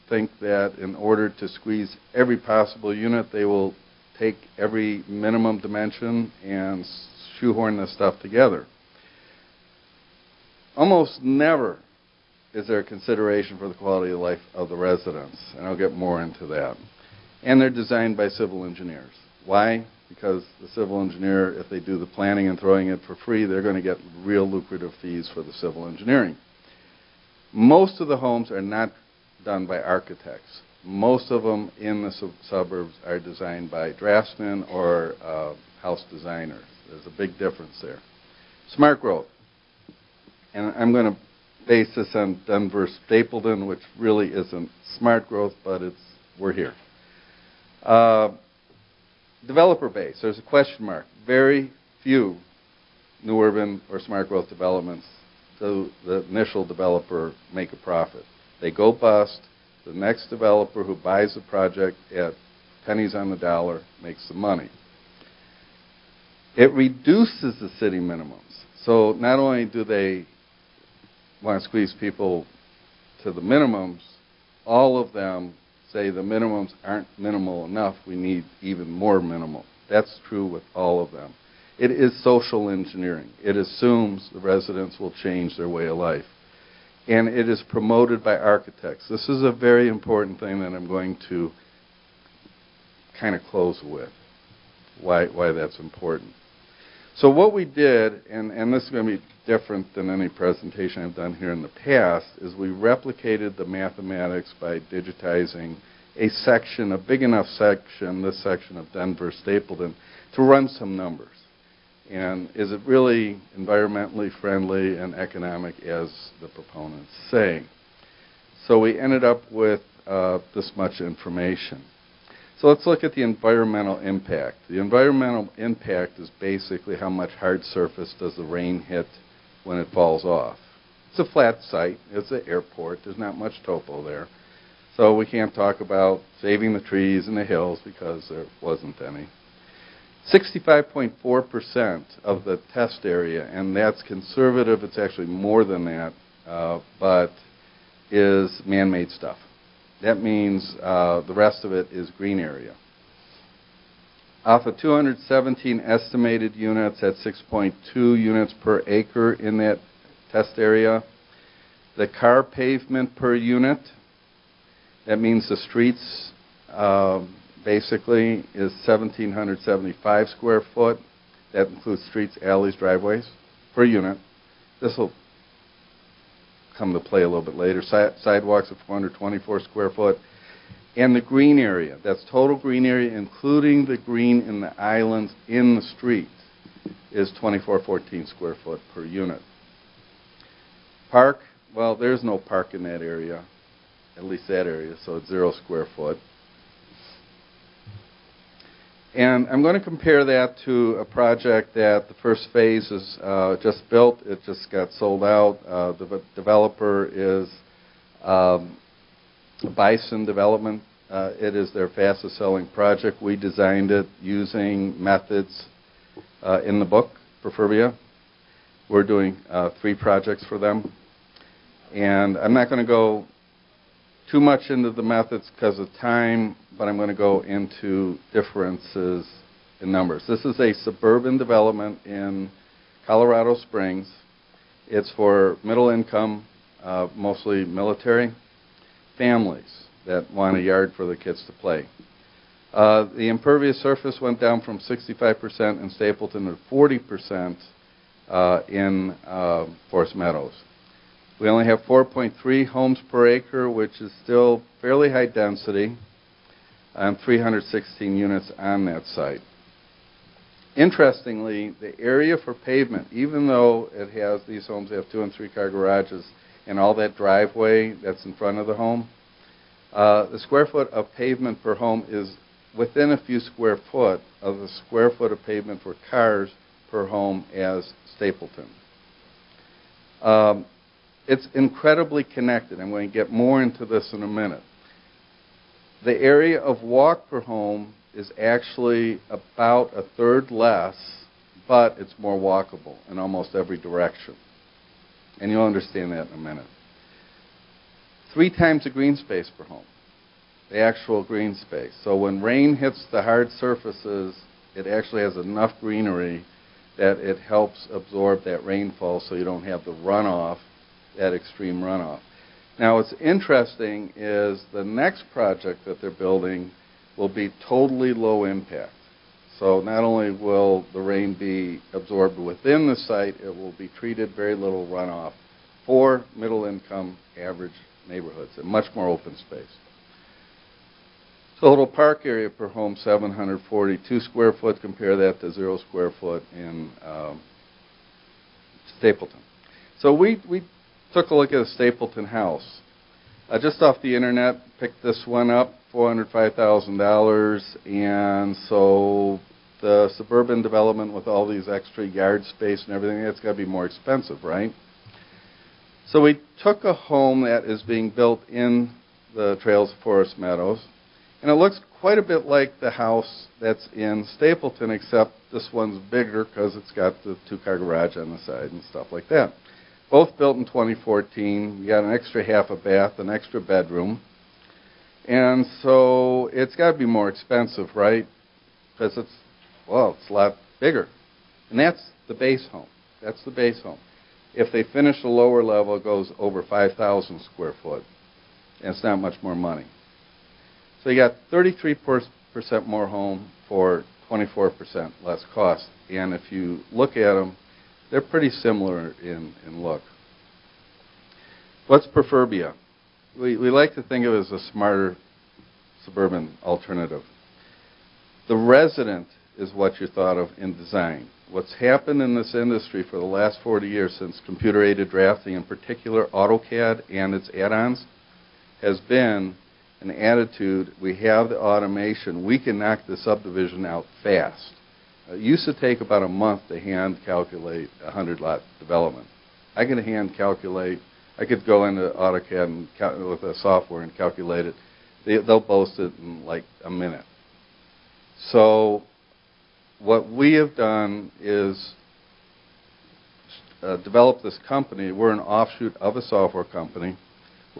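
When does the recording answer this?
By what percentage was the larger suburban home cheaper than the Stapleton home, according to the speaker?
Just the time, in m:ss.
6:34.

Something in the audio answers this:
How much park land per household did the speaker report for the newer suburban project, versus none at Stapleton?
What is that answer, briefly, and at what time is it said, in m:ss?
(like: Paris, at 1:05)
742 square feet, at 5:32.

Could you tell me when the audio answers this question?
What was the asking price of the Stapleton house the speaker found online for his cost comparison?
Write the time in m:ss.
5:45.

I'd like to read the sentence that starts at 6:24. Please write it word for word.
If they finish the lower level, it goes over 5,000 square foot.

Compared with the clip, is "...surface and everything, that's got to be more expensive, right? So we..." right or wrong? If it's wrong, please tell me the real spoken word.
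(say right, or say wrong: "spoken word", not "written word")
wrong: "space", not "surface".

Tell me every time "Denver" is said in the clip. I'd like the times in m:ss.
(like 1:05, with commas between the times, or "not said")
0:42, 1:48.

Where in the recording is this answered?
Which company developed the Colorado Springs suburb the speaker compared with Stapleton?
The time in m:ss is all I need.
3:29.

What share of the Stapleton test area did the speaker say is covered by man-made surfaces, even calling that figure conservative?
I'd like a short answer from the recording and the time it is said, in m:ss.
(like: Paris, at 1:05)
65.4%, at 2:20.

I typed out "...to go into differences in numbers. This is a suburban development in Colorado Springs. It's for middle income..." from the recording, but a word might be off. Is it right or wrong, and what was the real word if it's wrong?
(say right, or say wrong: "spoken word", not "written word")
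right.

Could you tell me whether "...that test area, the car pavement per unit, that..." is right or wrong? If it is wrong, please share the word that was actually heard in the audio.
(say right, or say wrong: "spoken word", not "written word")
right.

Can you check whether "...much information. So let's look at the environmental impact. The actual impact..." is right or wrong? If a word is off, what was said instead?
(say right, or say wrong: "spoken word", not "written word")
wrong: "environmental", not "actual".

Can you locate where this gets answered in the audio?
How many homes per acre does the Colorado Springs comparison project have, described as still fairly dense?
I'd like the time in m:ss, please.
4:11.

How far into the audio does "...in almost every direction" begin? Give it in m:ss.
4:53.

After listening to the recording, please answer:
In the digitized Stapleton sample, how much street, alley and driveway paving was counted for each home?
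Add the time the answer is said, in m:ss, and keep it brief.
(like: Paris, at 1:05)
1,775 square feet, at 2:48.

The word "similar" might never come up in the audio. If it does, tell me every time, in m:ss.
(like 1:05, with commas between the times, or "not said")
6:38.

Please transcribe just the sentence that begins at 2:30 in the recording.
That means uh, the rest of it is green area.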